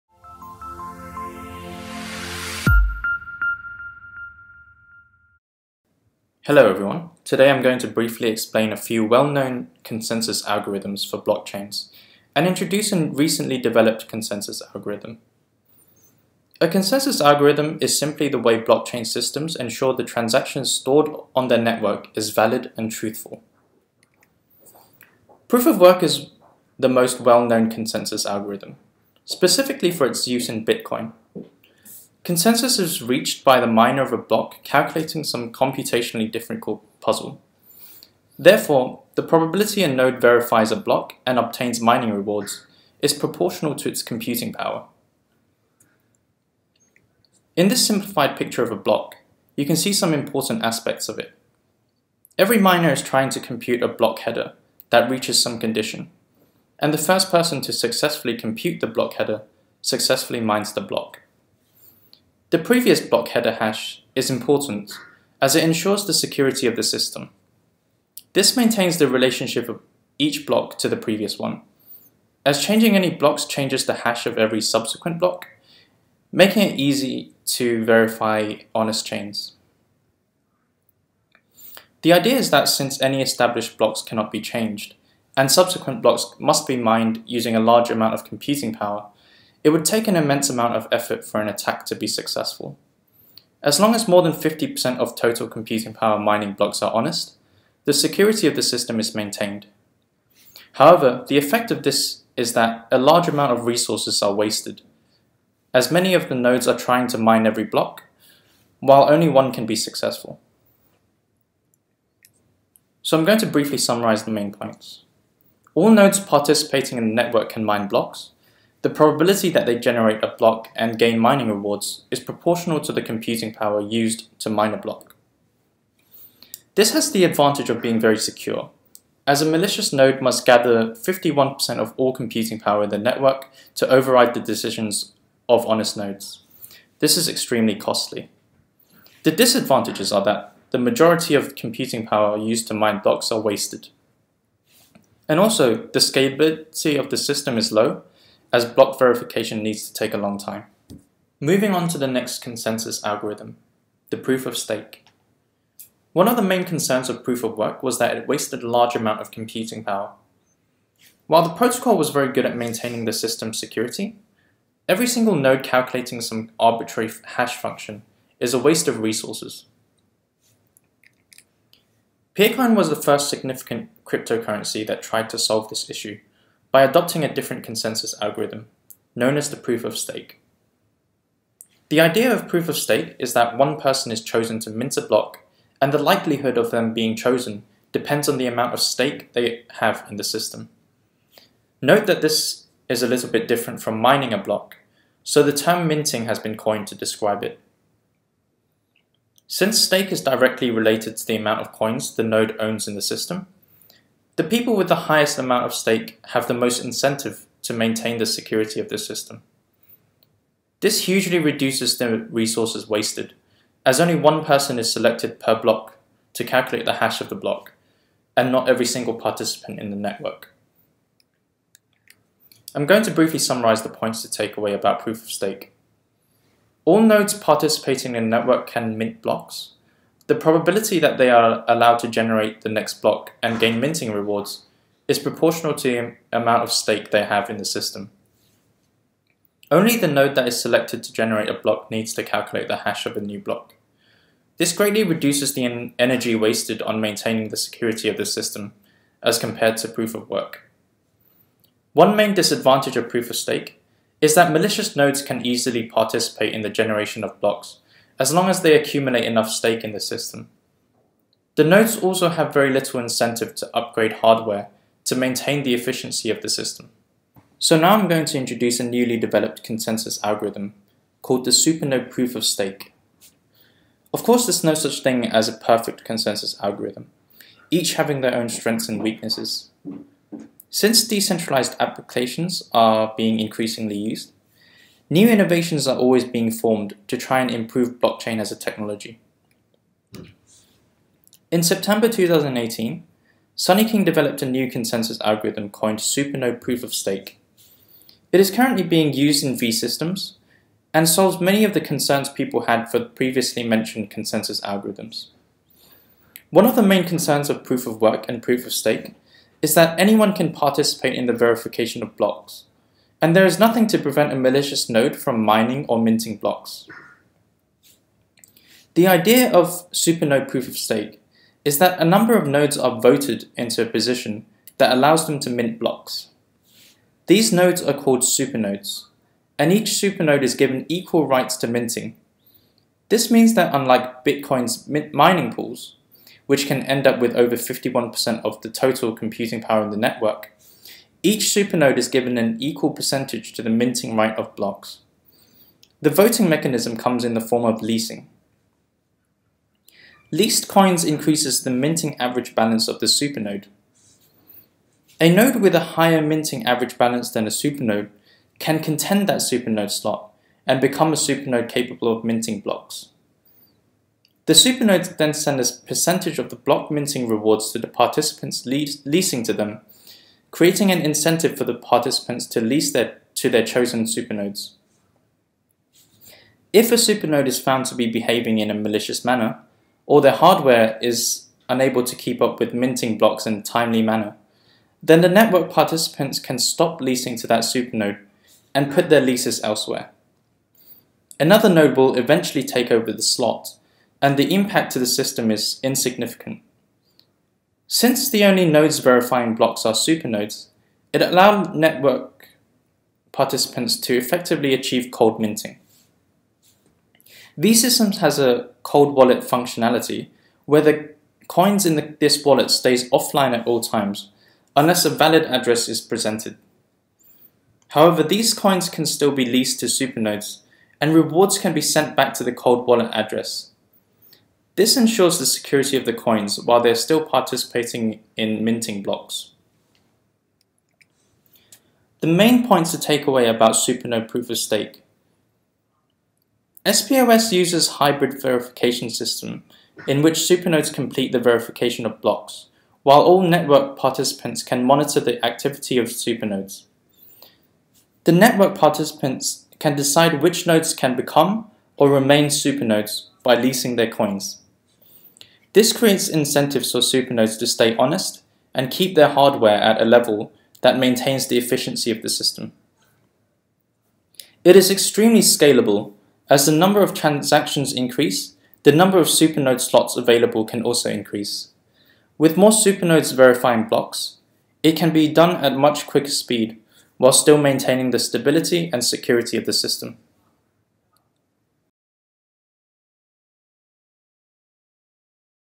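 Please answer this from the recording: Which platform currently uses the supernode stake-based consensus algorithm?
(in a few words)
V systems.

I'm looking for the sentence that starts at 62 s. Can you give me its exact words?
The previous block header hash is important as it ensures the security of the system.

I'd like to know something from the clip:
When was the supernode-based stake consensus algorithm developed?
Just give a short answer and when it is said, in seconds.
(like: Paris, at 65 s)
September 2018, at 291 s.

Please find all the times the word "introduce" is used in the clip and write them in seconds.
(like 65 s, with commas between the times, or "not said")
12 s, 268 s.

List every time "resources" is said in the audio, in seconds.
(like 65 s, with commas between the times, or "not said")
103 s, 168 s, 212 s.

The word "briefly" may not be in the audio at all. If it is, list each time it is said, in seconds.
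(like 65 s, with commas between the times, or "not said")
7 s, 113 s, 223 s.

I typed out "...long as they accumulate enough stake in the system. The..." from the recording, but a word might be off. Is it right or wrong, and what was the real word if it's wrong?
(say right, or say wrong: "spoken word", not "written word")
right.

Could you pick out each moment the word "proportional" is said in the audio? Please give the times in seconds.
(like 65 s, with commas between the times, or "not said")
43 s, 122 s, 235 s.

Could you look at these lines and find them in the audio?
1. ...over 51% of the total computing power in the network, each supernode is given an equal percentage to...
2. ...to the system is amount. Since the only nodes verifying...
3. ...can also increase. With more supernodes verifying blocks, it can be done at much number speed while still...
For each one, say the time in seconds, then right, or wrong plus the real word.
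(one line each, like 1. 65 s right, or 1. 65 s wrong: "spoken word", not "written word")
1. 337 s right
2. 394 s wrong: "insignificant", not "amount"
3. 470 s wrong: "quicker", not "number".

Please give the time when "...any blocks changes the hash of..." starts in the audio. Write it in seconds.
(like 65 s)
72 s.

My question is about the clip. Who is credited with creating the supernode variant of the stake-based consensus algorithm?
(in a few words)
Sunny King.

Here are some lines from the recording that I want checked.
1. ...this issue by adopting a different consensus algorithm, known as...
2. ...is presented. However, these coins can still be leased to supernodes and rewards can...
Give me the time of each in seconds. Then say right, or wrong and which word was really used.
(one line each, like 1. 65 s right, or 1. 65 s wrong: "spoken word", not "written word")
1. 175 s right
2. 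415 s right.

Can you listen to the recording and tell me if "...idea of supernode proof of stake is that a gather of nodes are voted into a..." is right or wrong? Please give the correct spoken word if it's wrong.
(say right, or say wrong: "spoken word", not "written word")
wrong: "number", not "gather".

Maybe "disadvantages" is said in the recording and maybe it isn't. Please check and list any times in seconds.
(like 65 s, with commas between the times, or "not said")
139 s, 252 s.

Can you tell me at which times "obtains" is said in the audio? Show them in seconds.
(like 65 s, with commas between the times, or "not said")
41 s.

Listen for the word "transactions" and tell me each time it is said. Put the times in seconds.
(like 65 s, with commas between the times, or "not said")
20 s, 467 s.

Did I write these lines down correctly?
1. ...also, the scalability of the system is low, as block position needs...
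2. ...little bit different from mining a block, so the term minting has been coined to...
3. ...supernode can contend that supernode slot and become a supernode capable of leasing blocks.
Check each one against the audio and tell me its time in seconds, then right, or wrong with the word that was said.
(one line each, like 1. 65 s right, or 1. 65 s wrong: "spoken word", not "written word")
1. 145 s wrong: "verification", not "position"
2. 193 s right
3. 357 s wrong: "minting", not "leasing".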